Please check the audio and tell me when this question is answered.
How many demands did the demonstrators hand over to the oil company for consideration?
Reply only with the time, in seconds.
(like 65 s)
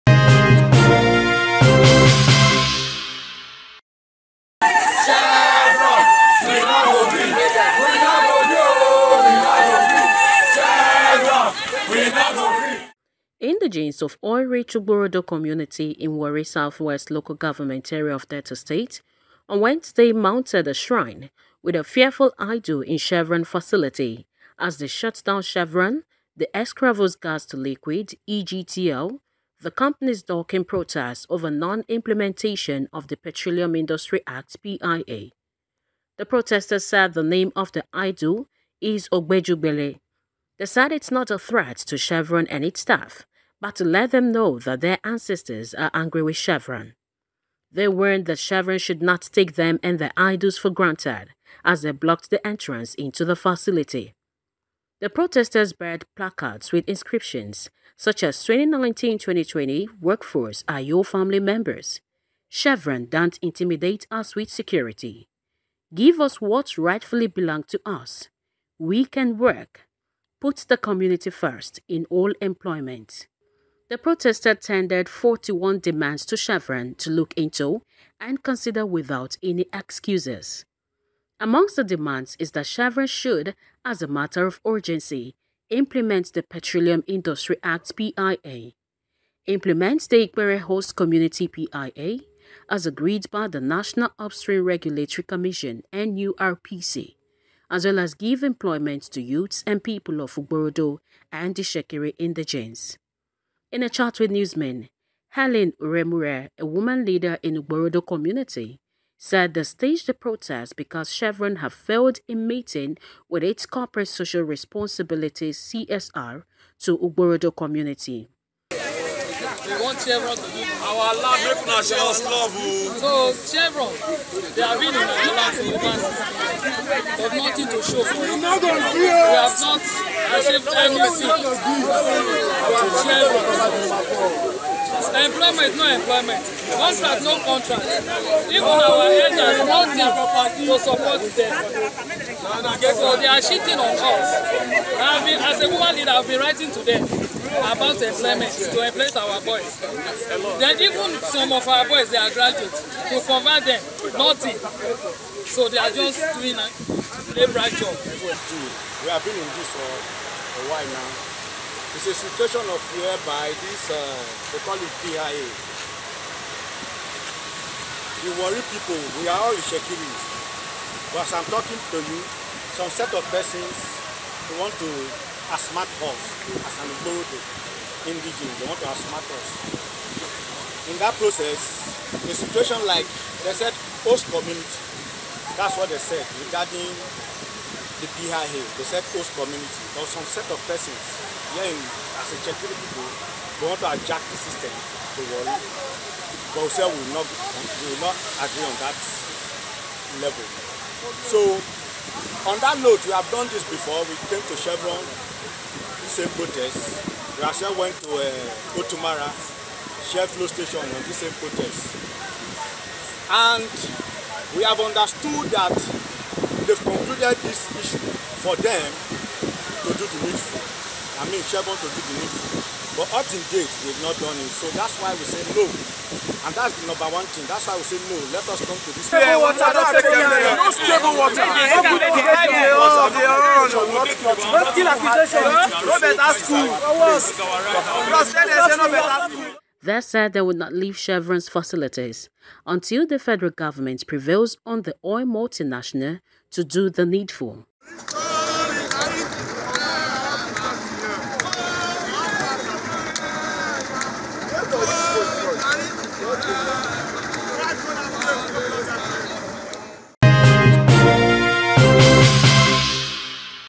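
75 s.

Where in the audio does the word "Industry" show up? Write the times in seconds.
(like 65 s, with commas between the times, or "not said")
33 s, 87 s.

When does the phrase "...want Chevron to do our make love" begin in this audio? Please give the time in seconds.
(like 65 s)
119 s.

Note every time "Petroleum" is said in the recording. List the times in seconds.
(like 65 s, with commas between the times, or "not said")
33 s, 86 s.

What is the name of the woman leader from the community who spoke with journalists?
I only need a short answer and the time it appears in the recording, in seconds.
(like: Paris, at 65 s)
Helen Uremure, at 105 s.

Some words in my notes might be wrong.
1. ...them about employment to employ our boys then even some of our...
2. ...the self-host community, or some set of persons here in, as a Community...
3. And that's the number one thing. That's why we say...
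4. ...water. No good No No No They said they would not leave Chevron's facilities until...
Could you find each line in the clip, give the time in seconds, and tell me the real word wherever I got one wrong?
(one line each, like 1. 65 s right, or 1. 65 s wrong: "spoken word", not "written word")
1. 146 s right
2. 188 s wrong: "Chetkiri", not "Community"
3. 226 s right
4. 231 s right.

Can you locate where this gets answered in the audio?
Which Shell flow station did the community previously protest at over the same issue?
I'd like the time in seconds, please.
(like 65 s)
208 s.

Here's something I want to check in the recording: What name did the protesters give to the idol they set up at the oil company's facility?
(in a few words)
Ogbejugbele.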